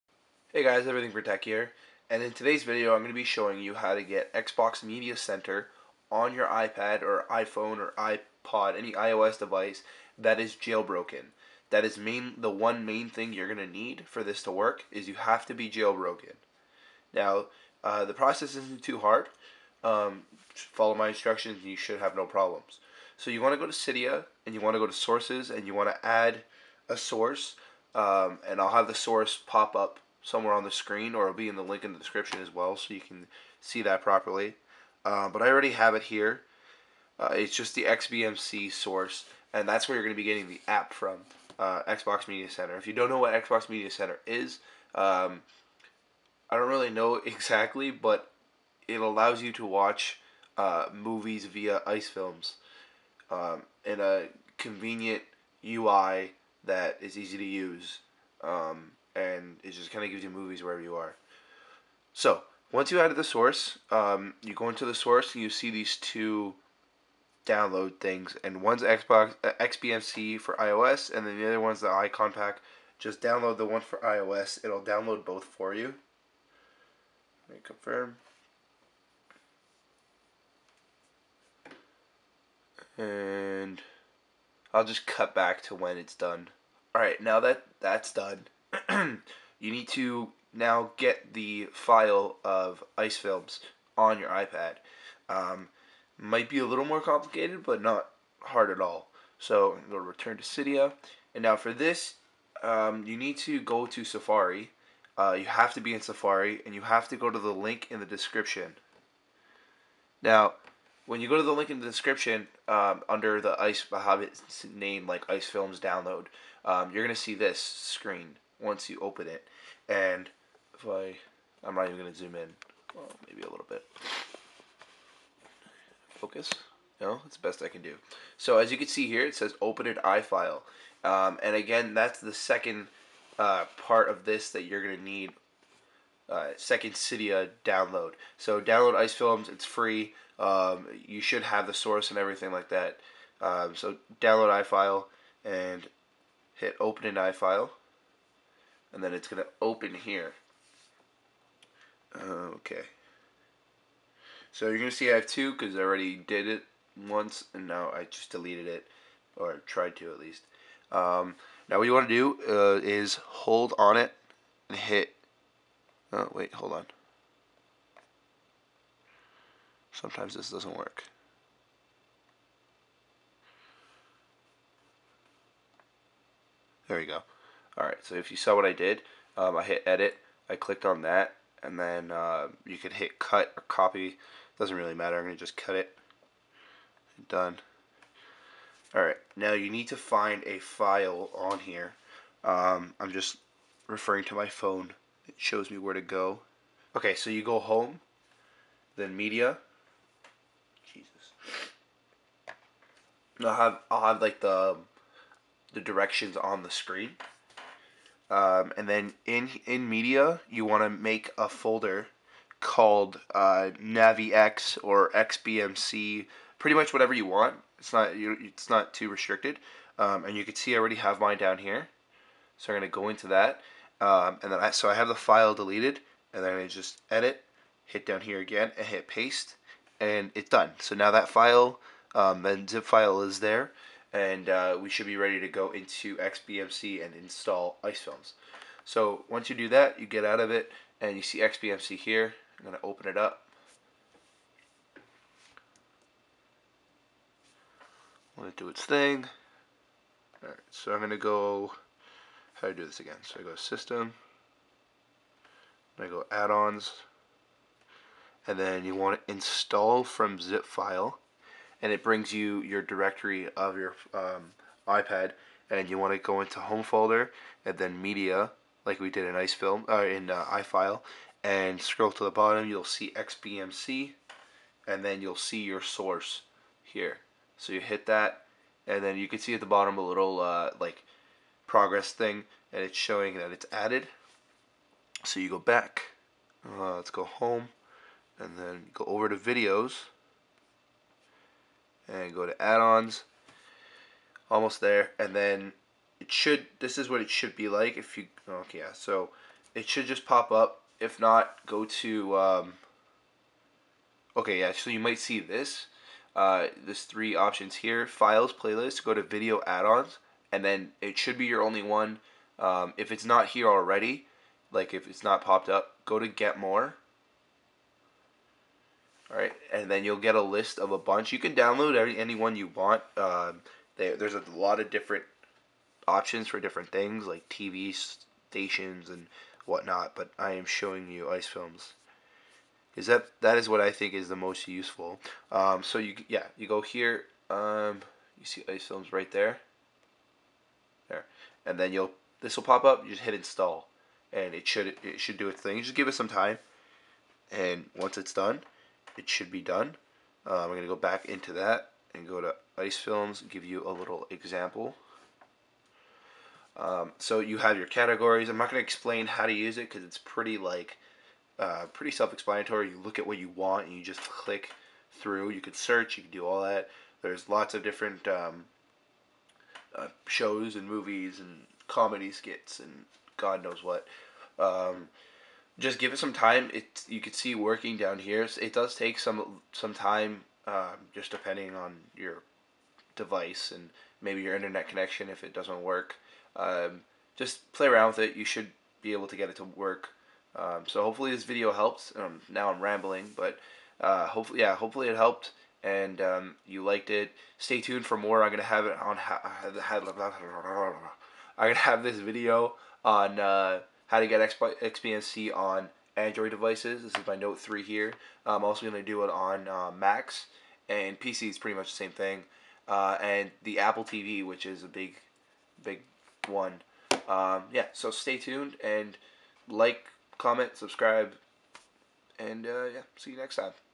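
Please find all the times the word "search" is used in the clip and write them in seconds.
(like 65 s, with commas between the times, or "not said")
365 s.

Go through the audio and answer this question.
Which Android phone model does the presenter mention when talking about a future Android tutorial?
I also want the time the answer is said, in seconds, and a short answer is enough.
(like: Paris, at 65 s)
Note 3, at 407 s.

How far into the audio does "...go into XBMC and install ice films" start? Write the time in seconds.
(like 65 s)
235 s.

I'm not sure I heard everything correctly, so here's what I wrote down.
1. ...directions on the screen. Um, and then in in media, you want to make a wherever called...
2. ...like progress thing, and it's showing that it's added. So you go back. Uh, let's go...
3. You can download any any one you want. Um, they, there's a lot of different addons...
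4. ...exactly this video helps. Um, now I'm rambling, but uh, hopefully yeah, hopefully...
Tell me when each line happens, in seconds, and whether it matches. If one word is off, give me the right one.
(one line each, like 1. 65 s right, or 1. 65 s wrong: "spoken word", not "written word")
1. 205 s wrong: "folder", not "wherever"
2. 280 s right
3. 321 s wrong: "options", not "addons"
4. 391 s wrong: "hopefully", not "exactly".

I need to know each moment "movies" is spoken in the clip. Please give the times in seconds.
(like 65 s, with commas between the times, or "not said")
50 s, 60 s, 370 s.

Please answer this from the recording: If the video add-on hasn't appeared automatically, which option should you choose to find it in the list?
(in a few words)
get more.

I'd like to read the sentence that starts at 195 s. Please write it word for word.
It shows me where to go.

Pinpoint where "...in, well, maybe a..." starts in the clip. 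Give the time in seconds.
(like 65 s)
122 s.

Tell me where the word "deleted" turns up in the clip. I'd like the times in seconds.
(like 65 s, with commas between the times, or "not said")
158 s, 225 s.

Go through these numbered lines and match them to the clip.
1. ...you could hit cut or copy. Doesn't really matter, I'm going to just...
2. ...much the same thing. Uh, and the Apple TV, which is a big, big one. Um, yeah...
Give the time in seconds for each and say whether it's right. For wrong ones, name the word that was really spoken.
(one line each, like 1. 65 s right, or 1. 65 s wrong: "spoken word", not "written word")
1. 182 s right
2. 411 s right.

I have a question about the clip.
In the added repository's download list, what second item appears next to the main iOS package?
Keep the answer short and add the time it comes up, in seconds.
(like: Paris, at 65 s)
Icon Pack, at 71 s.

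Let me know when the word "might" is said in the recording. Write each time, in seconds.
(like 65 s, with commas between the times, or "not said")
96 s, 304 s.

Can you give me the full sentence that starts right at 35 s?
Uh, but I already have it here.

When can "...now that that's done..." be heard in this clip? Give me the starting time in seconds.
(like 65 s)
87 s.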